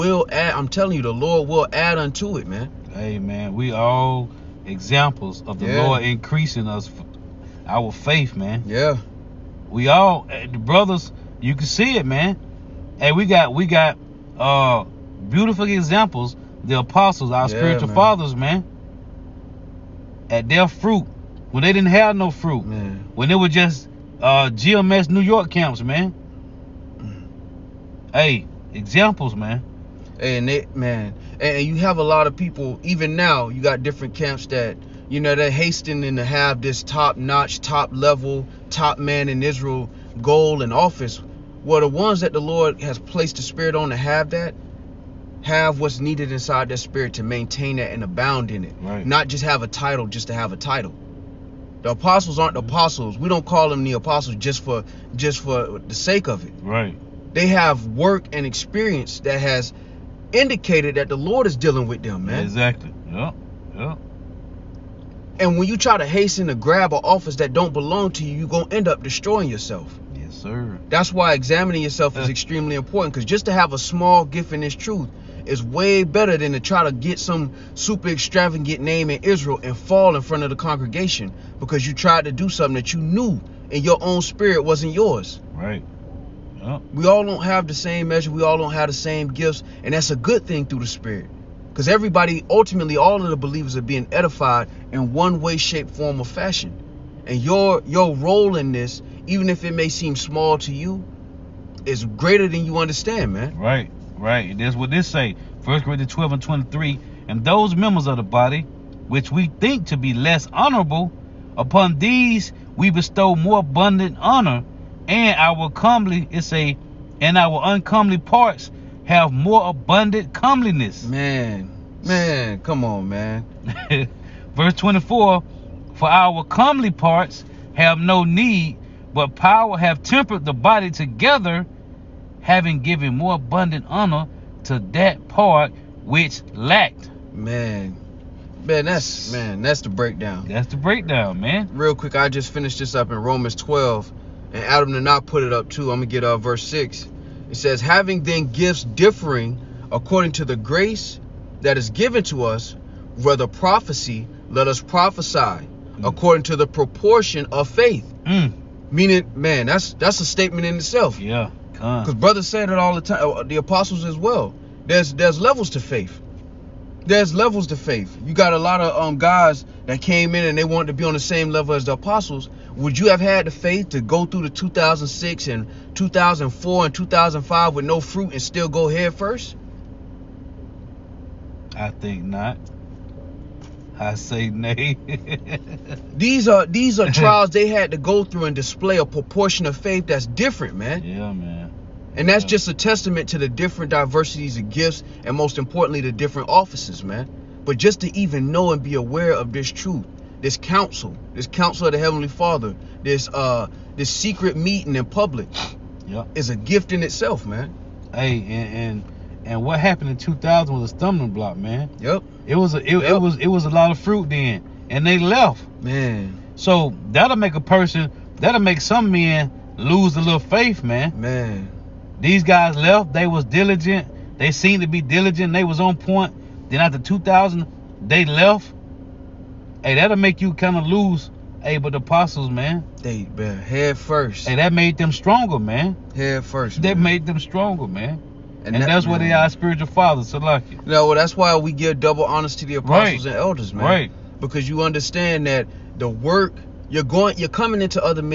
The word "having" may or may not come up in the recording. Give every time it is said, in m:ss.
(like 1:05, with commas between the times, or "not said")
2:12, 2:27.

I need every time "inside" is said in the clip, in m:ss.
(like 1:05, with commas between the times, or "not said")
0:46.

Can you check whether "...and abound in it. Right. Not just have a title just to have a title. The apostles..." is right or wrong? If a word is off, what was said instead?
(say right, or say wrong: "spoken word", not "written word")
right.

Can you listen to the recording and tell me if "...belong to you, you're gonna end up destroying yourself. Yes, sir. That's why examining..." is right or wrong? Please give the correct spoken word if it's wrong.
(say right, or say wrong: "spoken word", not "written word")
right.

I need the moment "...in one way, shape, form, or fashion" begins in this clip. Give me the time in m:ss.
1:34.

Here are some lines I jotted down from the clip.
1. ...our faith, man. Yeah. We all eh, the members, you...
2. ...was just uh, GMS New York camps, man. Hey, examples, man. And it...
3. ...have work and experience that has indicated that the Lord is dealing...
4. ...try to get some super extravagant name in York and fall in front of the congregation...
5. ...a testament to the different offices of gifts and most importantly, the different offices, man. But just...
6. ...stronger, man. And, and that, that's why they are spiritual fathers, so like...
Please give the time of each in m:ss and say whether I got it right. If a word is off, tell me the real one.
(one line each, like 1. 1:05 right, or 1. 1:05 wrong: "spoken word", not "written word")
1. 0:07 wrong: "brothers", not "members"
2. 0:23 right
3. 0:57 right
4. 1:16 wrong: "Israel", not "York"
5. 3:12 wrong: "diversities", not "offices"
6. 3:57 right.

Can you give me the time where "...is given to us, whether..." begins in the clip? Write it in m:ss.
2:31.